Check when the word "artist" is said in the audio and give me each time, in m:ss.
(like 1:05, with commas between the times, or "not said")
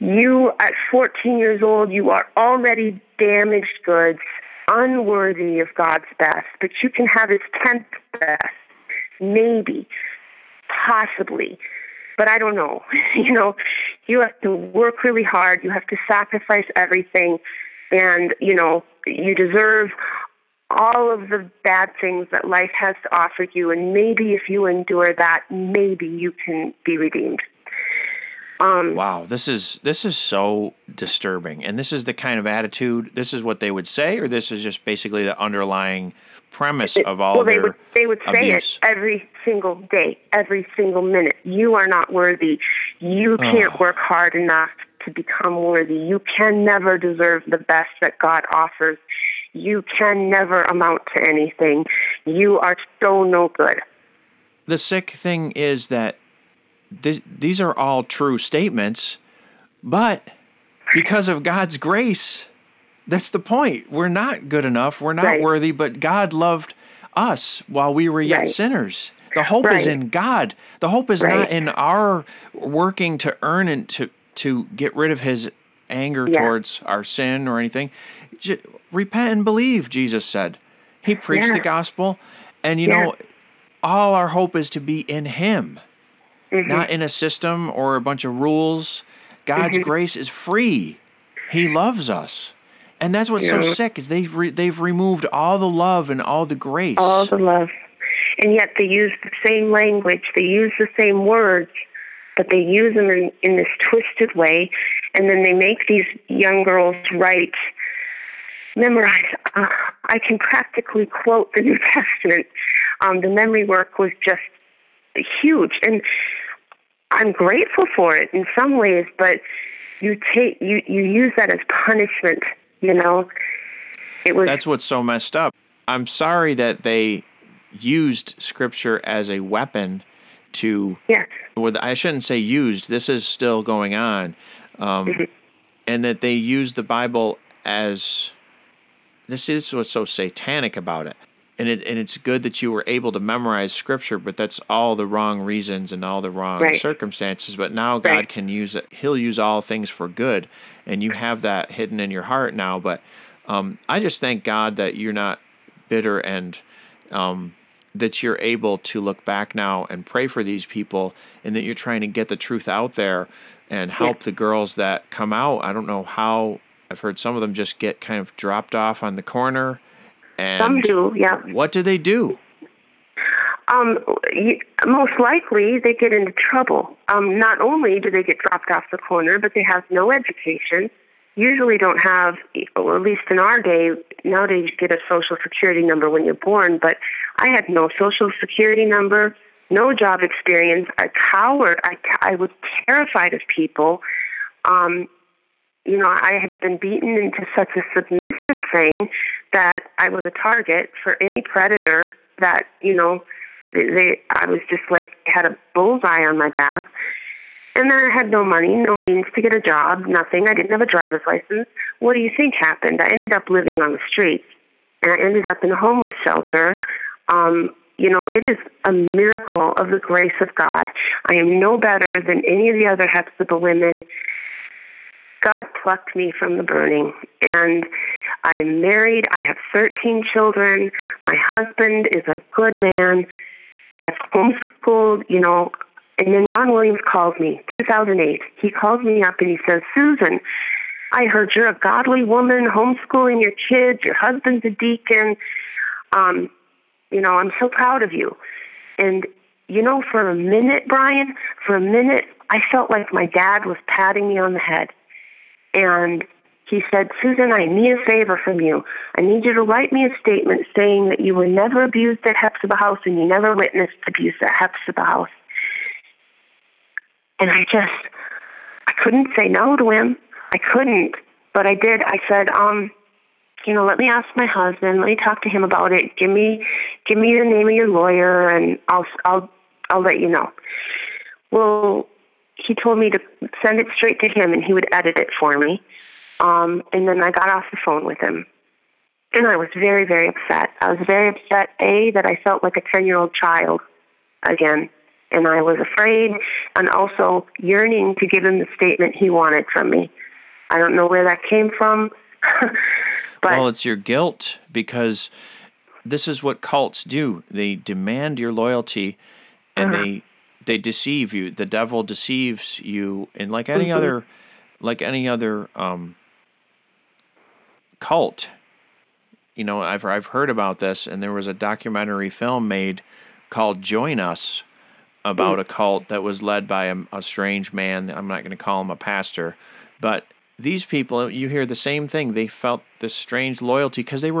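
not said.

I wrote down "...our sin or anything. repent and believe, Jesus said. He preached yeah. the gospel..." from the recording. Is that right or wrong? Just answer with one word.
right.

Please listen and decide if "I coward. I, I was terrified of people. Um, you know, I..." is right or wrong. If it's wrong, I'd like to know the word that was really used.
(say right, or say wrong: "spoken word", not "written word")
right.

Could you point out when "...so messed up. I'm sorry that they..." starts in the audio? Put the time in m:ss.
2:04.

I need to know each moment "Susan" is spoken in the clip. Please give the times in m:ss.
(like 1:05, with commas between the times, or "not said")
3:59, 4:17.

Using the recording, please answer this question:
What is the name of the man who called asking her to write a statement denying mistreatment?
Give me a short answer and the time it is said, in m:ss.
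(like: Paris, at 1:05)
Ron Williams, at 3:56.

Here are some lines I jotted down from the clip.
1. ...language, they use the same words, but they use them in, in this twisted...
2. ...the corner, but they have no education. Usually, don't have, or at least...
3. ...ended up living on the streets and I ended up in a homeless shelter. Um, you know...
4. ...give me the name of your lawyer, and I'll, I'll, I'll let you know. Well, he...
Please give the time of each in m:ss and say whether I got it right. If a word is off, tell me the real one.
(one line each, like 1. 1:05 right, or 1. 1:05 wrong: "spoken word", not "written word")
1. 1:39 right
2. 2:58 right
3. 3:33 right
4. 4:37 right.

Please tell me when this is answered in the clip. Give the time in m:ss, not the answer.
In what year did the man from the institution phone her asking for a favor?
3:57.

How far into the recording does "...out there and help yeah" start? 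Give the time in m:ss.
2:42.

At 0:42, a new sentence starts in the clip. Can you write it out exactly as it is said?
You can't work hard enough to become worthy.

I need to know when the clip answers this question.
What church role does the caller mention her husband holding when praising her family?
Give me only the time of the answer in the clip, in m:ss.
4:04.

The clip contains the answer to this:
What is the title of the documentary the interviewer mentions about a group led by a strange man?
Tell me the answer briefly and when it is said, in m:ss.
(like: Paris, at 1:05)
Join Us, at 5:23.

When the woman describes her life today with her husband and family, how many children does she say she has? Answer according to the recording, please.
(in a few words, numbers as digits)
13.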